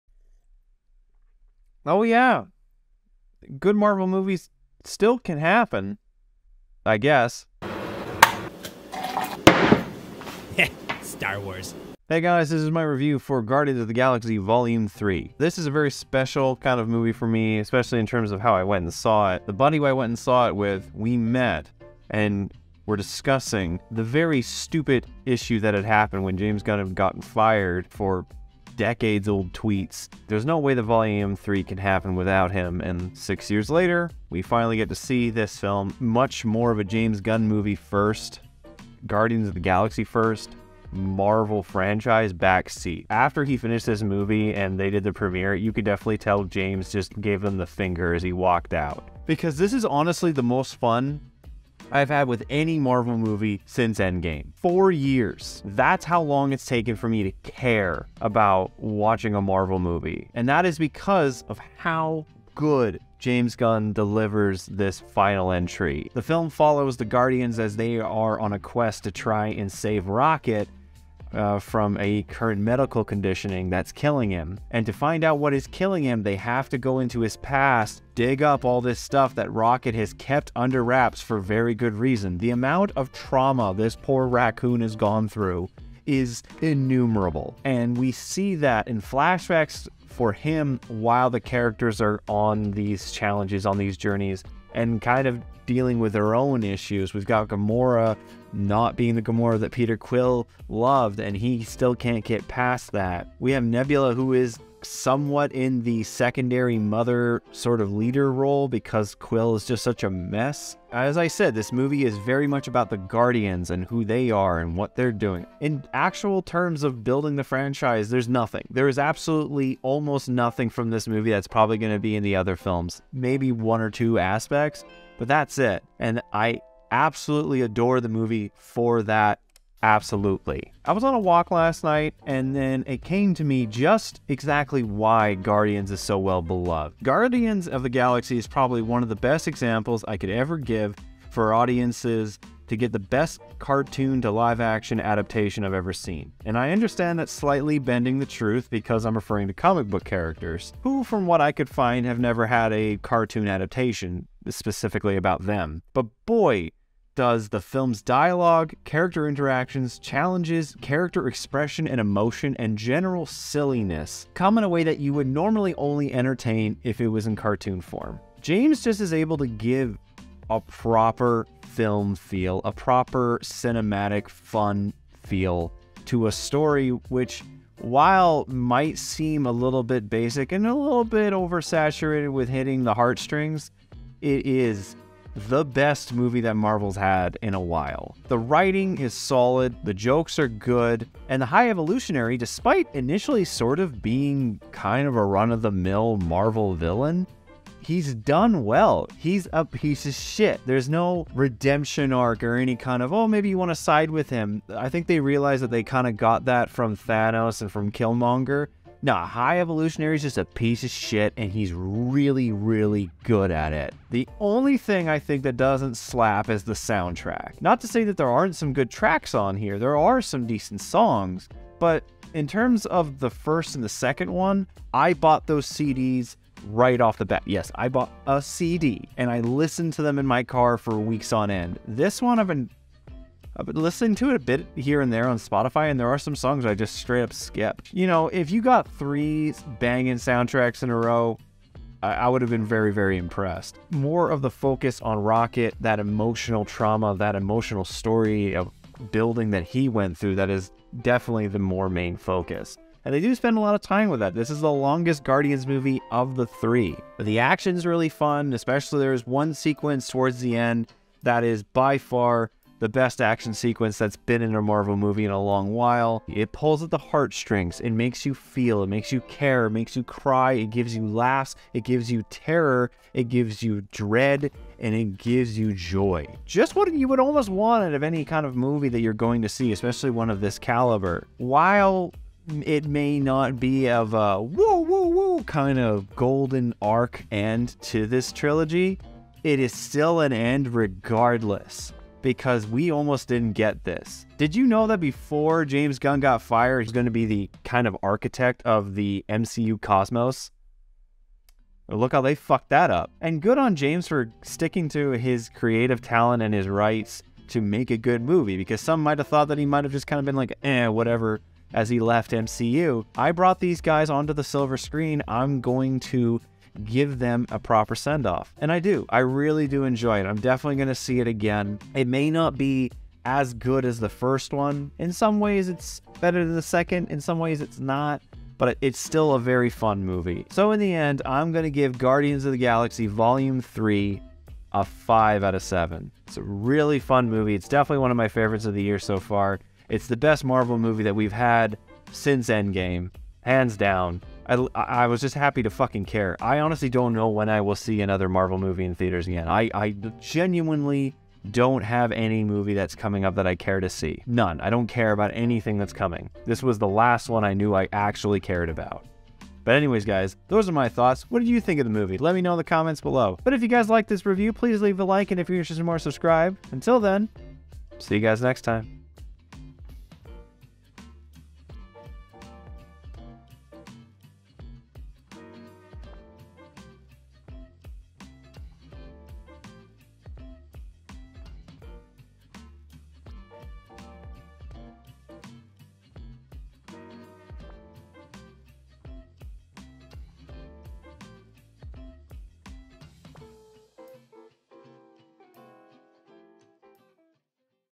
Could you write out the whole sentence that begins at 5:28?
But it's still a very fun movie.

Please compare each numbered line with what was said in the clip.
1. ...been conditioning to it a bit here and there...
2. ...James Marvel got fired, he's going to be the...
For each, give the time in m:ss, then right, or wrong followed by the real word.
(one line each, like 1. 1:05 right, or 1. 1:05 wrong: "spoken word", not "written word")
1. 3:53 wrong: "listening", not "conditioning"
2. 4:55 wrong: "Gunn", not "Marvel".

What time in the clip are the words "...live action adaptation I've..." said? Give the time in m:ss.
2:24.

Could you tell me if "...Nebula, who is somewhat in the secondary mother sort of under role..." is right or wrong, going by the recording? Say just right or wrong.
wrong.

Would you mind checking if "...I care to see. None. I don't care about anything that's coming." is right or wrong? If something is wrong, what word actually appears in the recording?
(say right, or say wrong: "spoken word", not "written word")
right.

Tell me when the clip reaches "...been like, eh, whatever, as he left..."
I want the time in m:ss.
5:10.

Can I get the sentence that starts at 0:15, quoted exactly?
This is a very special kind of movie for me, especially in terms of how I went and saw it.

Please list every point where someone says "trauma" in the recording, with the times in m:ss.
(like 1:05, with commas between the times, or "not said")
1:23, 4:06.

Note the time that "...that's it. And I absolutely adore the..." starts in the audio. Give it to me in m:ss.
2:05.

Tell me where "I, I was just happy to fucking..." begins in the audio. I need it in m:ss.
5:44.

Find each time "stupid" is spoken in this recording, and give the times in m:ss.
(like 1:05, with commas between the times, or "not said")
0:24.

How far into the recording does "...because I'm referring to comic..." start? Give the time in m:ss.
2:28.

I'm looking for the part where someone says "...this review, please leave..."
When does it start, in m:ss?
6:04.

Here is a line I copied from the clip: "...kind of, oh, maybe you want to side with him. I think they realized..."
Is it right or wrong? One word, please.
right.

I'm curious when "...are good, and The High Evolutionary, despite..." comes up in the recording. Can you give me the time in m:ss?
3:10.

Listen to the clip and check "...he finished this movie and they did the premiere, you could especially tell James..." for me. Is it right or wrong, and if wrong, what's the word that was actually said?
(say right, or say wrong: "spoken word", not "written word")
wrong: "definitely", not "especially".